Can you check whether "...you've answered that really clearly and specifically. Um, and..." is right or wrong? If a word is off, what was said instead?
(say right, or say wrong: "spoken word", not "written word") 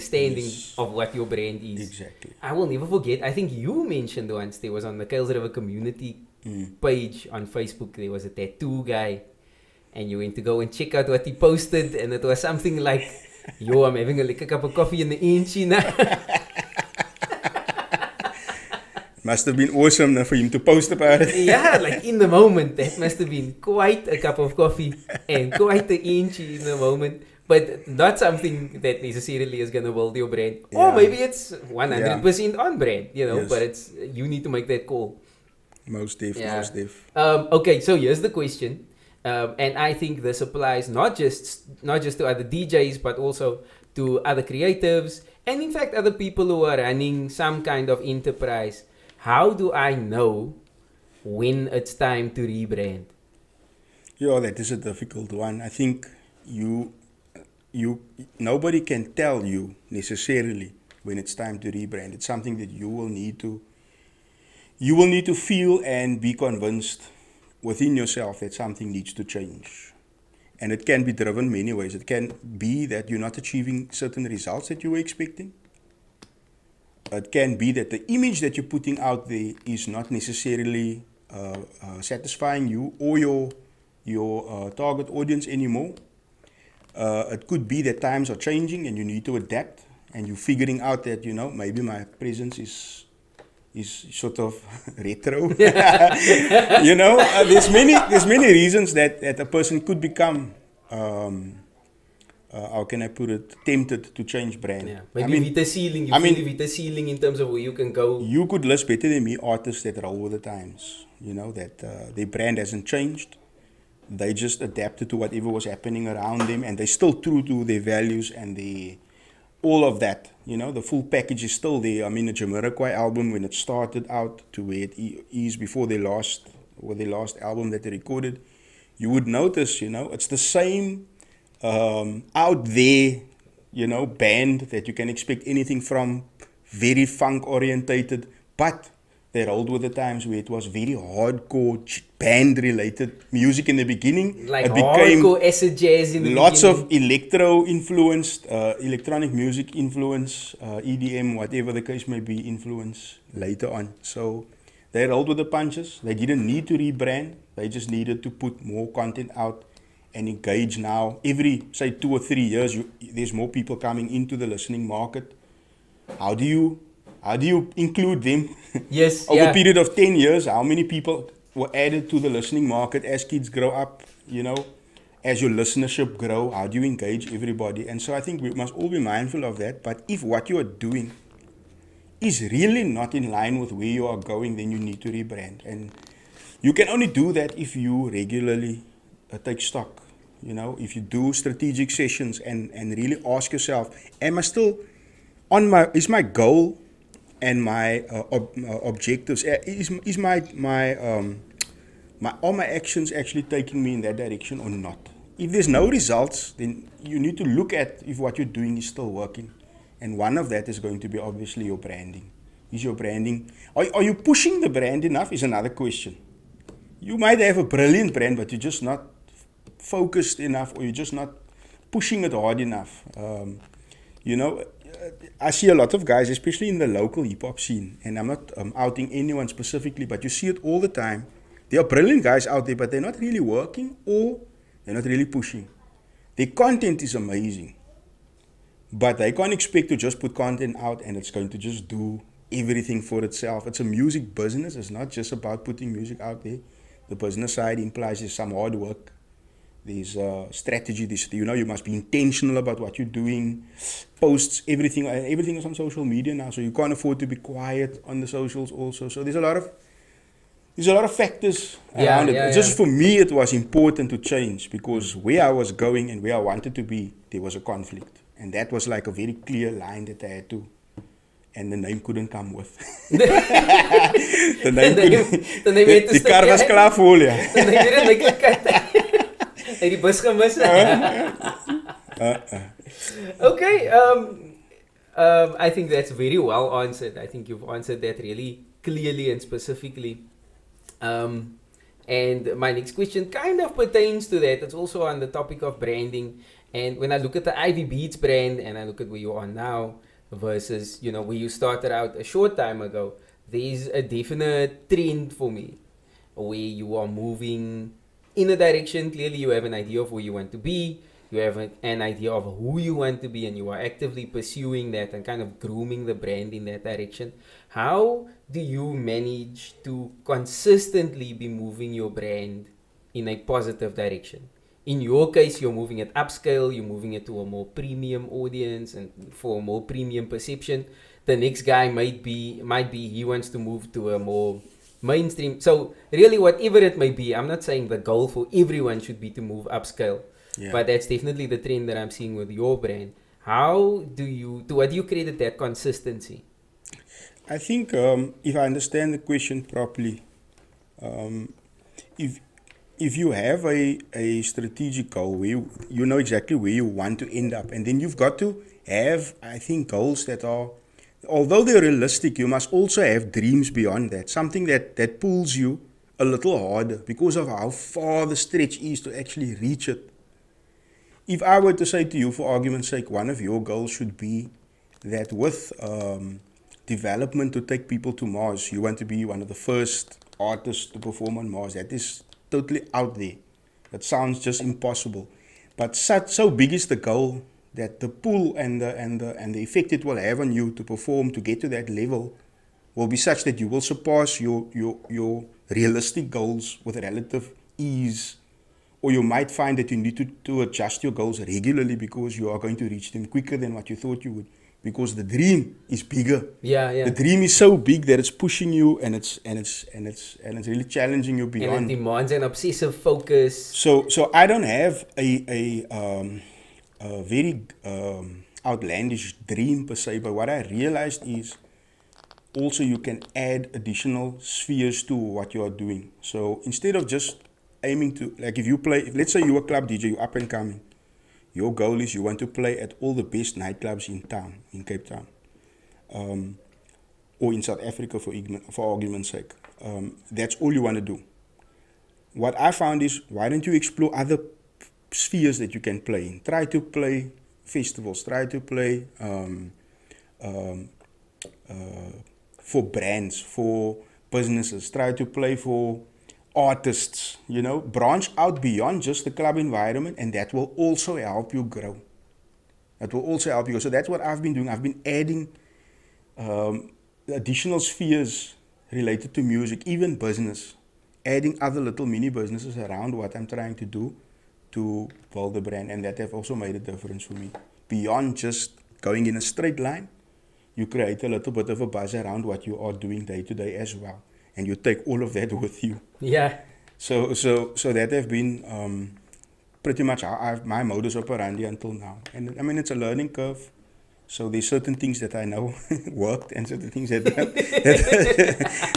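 right.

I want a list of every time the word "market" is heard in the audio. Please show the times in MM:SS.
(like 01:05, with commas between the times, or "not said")
02:44, 02:52.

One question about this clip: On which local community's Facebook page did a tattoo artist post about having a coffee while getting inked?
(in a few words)
Kuils River.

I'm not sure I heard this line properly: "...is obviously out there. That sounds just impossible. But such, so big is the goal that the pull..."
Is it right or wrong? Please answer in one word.
wrong.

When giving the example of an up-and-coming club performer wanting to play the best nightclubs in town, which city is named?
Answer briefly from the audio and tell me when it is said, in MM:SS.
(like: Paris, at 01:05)
Cape Town, at 07:14.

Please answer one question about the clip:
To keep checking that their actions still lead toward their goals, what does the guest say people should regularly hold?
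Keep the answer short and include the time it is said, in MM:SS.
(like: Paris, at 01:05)
strategic sessions, at 03:11.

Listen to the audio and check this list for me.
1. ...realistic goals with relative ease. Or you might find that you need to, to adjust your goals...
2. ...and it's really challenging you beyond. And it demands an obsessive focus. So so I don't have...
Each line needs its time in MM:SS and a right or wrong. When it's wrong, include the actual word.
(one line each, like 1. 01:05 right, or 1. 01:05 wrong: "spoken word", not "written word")
1. 06:35 right
2. 06:50 right.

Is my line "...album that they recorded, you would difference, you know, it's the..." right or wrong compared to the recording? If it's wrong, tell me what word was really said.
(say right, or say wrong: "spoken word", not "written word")
wrong: "notice", not "difference".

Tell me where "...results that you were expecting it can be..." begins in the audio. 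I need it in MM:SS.
01:14.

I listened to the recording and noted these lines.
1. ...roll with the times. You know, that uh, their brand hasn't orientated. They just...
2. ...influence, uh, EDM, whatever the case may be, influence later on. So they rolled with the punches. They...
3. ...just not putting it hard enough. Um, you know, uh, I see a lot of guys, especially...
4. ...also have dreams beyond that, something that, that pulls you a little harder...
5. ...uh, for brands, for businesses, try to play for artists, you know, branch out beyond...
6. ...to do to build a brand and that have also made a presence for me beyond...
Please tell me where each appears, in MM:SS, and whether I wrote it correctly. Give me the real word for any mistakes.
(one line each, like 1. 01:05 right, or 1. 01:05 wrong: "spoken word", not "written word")
1. 01:50 wrong: "changed", not "orientated"
2. 02:29 right
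3. 03:41 wrong: "pushing", not "putting"
4. 06:02 right
5. 07:31 right
6. 07:53 wrong: "difference", not "presence".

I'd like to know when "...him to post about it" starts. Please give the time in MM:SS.
00:20.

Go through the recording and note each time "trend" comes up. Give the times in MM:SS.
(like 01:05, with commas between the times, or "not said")
05:04, 05:41.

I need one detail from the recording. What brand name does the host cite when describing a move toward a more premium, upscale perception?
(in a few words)
IV Beats.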